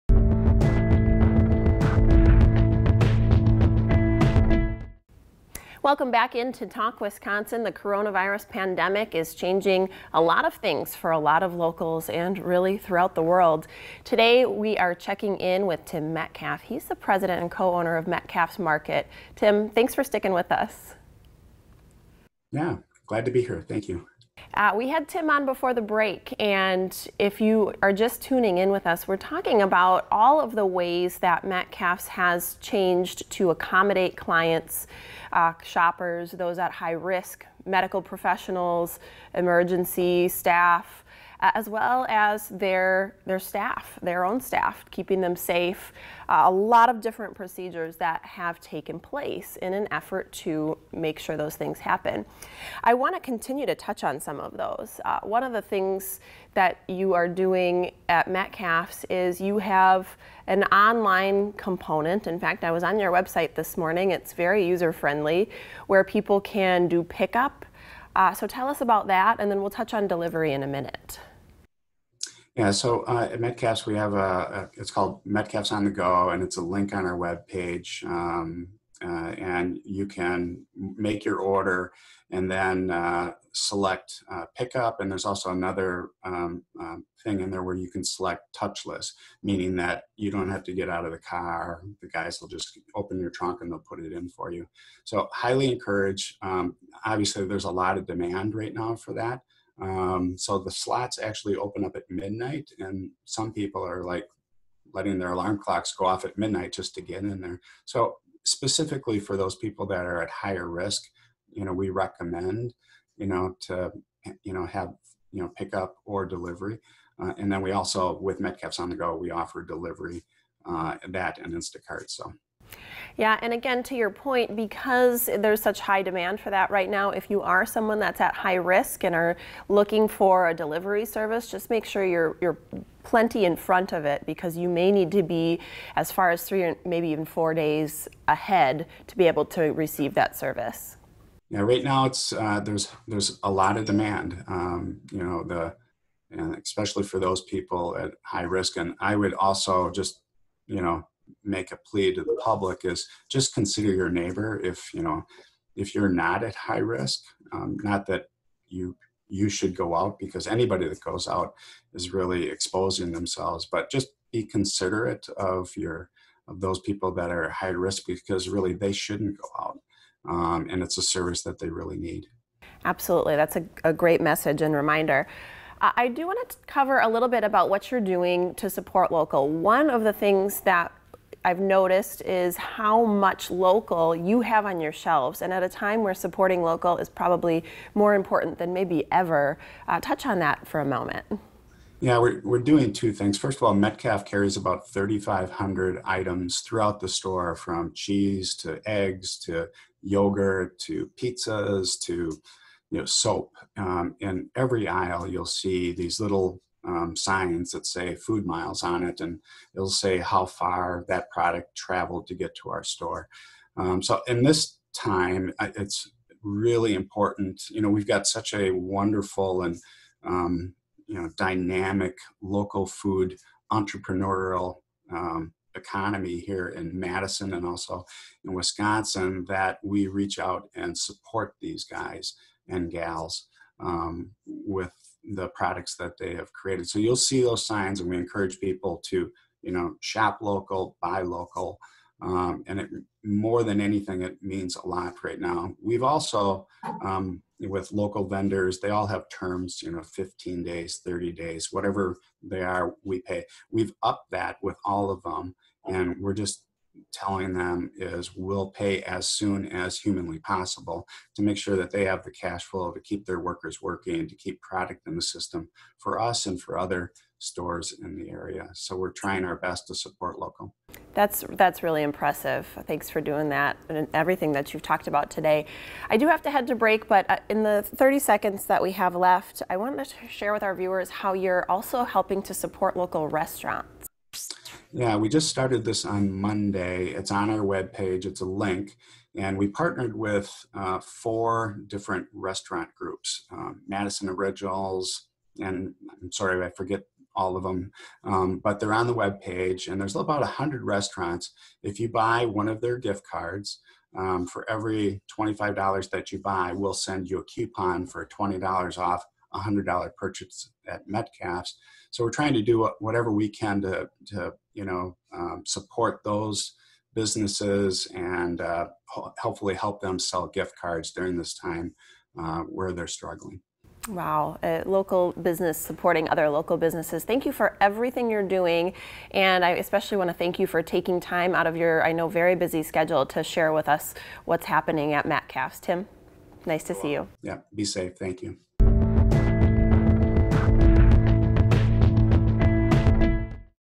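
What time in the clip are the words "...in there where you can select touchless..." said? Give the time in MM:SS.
01:27.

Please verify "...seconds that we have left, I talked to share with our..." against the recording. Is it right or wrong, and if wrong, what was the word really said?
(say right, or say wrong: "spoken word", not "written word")
wrong: "wanted", not "talked".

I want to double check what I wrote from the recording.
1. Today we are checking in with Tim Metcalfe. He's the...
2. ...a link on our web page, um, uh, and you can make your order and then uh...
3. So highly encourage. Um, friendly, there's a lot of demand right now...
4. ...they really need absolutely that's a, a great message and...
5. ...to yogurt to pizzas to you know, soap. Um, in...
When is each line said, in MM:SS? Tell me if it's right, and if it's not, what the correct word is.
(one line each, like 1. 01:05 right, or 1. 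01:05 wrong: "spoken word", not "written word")
1. 00:14 right
2. 01:16 right
3. 01:35 wrong: "obviously", not "friendly"
4. 02:51 right
5. 03:19 right.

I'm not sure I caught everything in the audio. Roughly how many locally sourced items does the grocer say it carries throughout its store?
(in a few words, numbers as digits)
3,500.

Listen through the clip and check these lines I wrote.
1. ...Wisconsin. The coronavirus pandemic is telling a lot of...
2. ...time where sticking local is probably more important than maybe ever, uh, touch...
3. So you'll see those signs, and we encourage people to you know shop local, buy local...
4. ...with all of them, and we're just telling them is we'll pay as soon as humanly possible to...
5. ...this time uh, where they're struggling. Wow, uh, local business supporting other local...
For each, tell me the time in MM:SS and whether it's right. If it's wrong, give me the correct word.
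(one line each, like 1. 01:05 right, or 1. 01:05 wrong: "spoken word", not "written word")
1. 00:07 wrong: "changing", not "telling"
2. 03:05 wrong: "supporting", not "sticking"
3. 03:56 right
4. 04:14 right
5. 05:21 right.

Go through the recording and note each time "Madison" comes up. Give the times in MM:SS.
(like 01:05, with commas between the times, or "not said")
03:46, 04:53.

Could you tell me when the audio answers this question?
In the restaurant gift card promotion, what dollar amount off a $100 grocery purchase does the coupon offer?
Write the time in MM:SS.
05:08.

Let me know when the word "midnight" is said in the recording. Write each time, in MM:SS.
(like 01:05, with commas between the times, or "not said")
01:42, 01:46.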